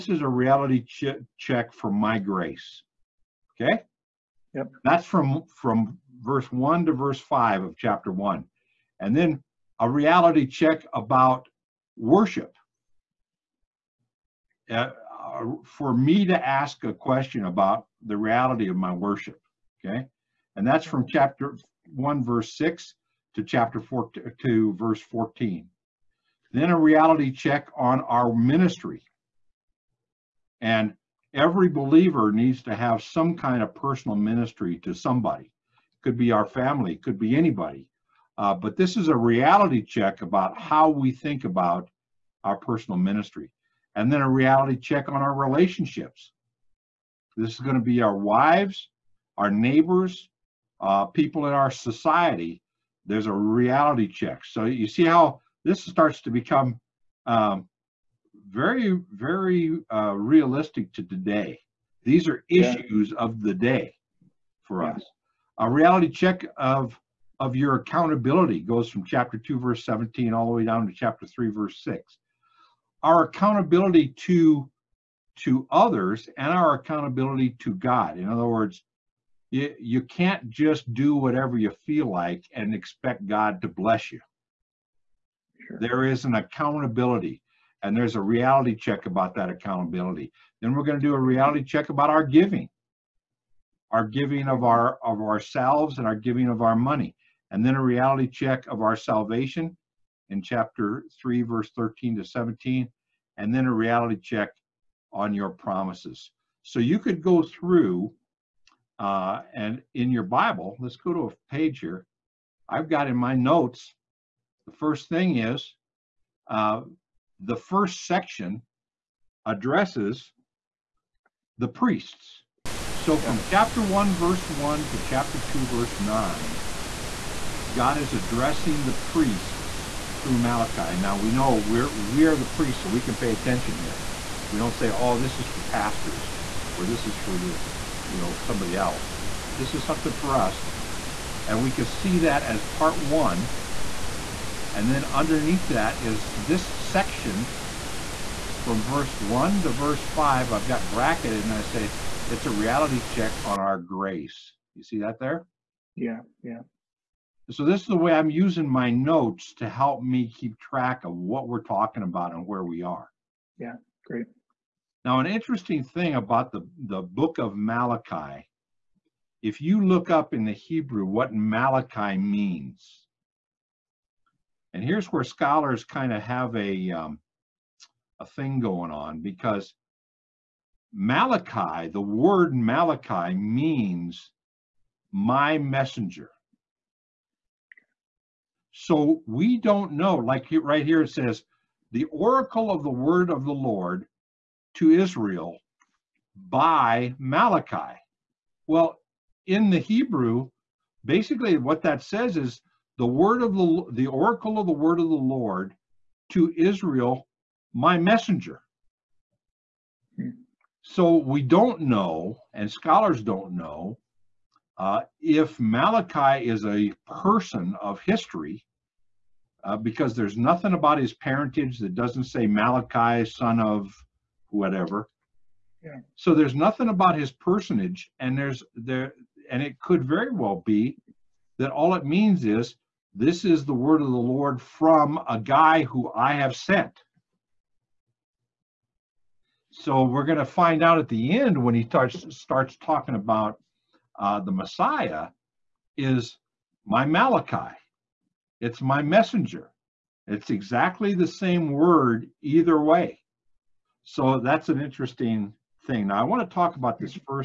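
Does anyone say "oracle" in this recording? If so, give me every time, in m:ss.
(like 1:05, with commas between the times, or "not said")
3:12, 3:24.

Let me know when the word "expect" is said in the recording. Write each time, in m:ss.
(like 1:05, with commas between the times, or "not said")
1:22.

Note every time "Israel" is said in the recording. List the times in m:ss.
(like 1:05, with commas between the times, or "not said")
3:14, 3:26.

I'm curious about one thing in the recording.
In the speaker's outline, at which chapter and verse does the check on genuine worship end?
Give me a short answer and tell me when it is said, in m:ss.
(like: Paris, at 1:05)
Chapter 4, verse 14, at 0:23.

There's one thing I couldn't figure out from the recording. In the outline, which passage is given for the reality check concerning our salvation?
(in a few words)
Chapter 3, verses 13 to 17.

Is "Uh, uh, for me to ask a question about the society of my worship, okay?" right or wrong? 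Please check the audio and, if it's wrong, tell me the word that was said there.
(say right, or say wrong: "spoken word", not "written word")
wrong: "reality", not "society".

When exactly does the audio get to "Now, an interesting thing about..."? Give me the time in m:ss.
2:45.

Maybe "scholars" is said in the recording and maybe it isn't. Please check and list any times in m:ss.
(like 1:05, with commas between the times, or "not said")
2:55, 3:32.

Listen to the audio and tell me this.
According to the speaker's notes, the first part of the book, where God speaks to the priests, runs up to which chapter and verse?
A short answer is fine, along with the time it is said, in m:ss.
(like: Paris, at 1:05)
Chapter 2, verse 9, at 2:04.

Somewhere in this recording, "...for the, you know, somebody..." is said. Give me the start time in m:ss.
2:17.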